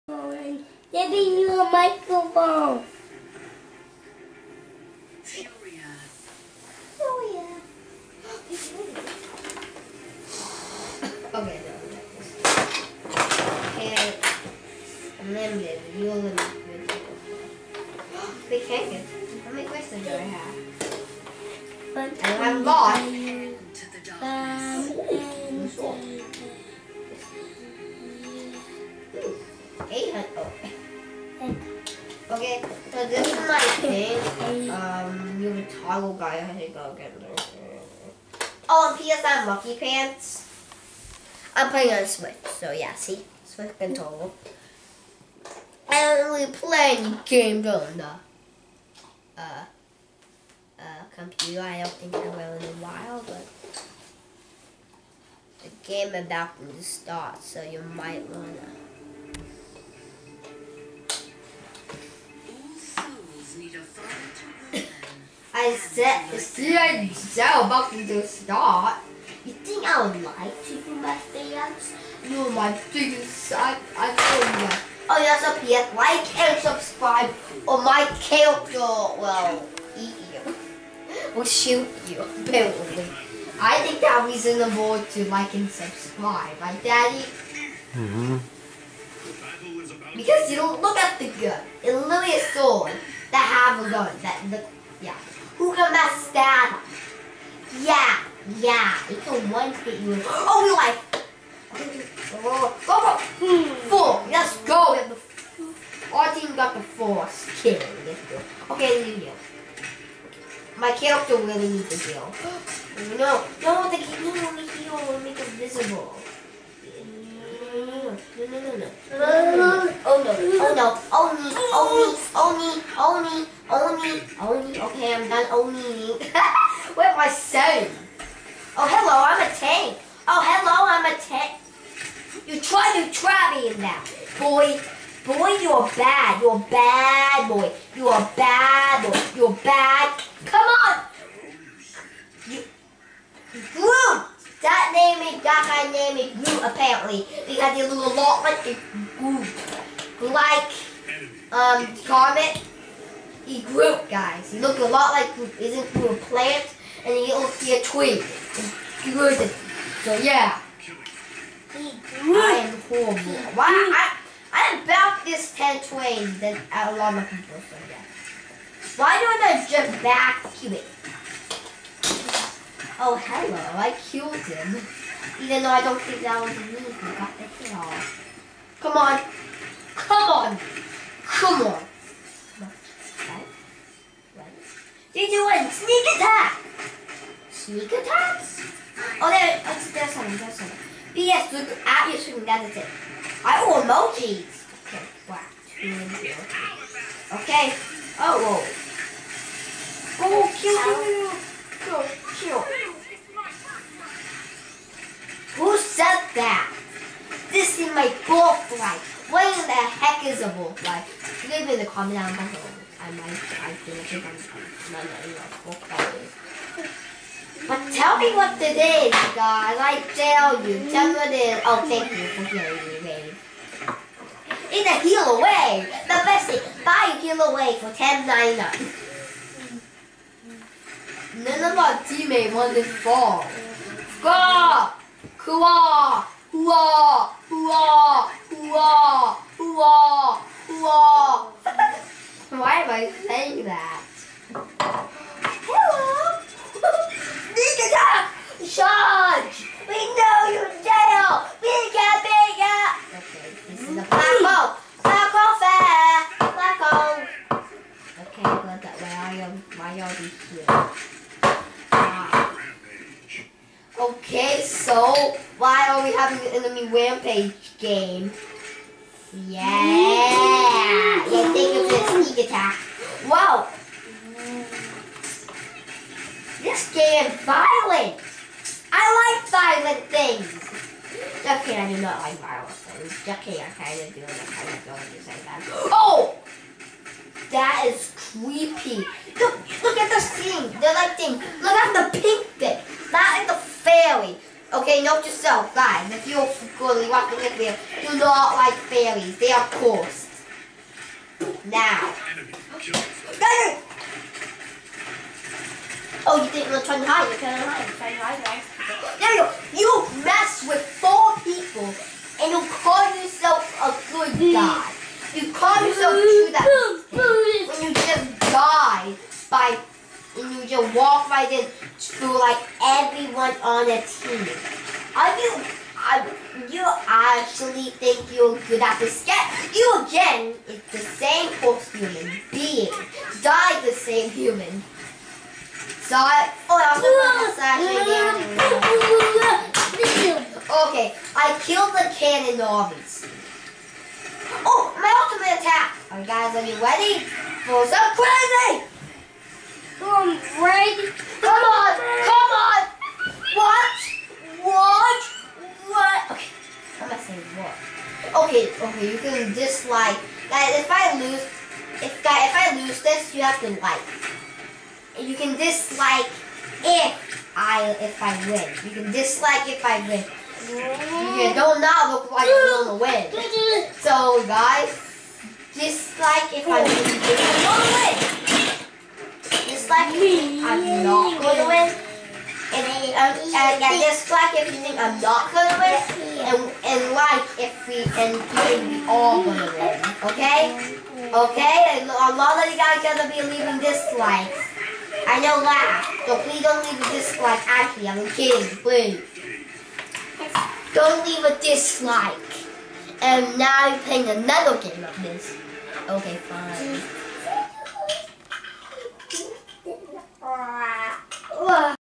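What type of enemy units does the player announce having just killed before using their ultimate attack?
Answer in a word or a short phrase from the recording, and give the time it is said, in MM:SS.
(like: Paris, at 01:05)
cannon armies, at 05:42.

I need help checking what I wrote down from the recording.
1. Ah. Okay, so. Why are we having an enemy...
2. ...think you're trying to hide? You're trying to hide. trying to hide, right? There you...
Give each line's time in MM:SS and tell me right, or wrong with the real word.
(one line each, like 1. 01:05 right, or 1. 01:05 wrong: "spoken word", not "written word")
1. 04:21 right
2. 05:06 right.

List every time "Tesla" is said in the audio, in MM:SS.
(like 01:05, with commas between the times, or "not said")
not said.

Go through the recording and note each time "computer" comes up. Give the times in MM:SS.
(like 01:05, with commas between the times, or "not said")
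00:51.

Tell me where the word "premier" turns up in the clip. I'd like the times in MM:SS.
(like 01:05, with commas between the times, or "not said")
not said.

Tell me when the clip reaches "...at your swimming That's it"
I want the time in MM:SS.
03:11.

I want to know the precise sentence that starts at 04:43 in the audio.
Okay, I kind of do, I kind of don't do that.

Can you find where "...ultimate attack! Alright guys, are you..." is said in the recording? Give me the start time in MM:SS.
05:45.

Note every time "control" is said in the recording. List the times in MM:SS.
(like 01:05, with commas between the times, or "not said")
00:43.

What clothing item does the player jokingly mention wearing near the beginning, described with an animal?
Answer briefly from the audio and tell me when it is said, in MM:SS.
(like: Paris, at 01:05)
monkey pants, at 00:39.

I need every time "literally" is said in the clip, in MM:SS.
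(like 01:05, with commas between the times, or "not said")
01:31.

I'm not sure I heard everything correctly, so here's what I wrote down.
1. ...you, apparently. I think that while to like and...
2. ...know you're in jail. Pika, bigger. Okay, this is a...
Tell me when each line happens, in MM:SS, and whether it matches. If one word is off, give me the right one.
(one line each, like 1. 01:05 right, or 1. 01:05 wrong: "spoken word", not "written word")
1. 01:22 wrong: "reasonable", not "while"
2. 04:09 right.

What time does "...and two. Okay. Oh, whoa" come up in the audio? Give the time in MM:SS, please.
03:15.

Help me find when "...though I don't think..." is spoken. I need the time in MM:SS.
02:55.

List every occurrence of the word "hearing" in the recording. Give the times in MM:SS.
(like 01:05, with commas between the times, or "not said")
03:42.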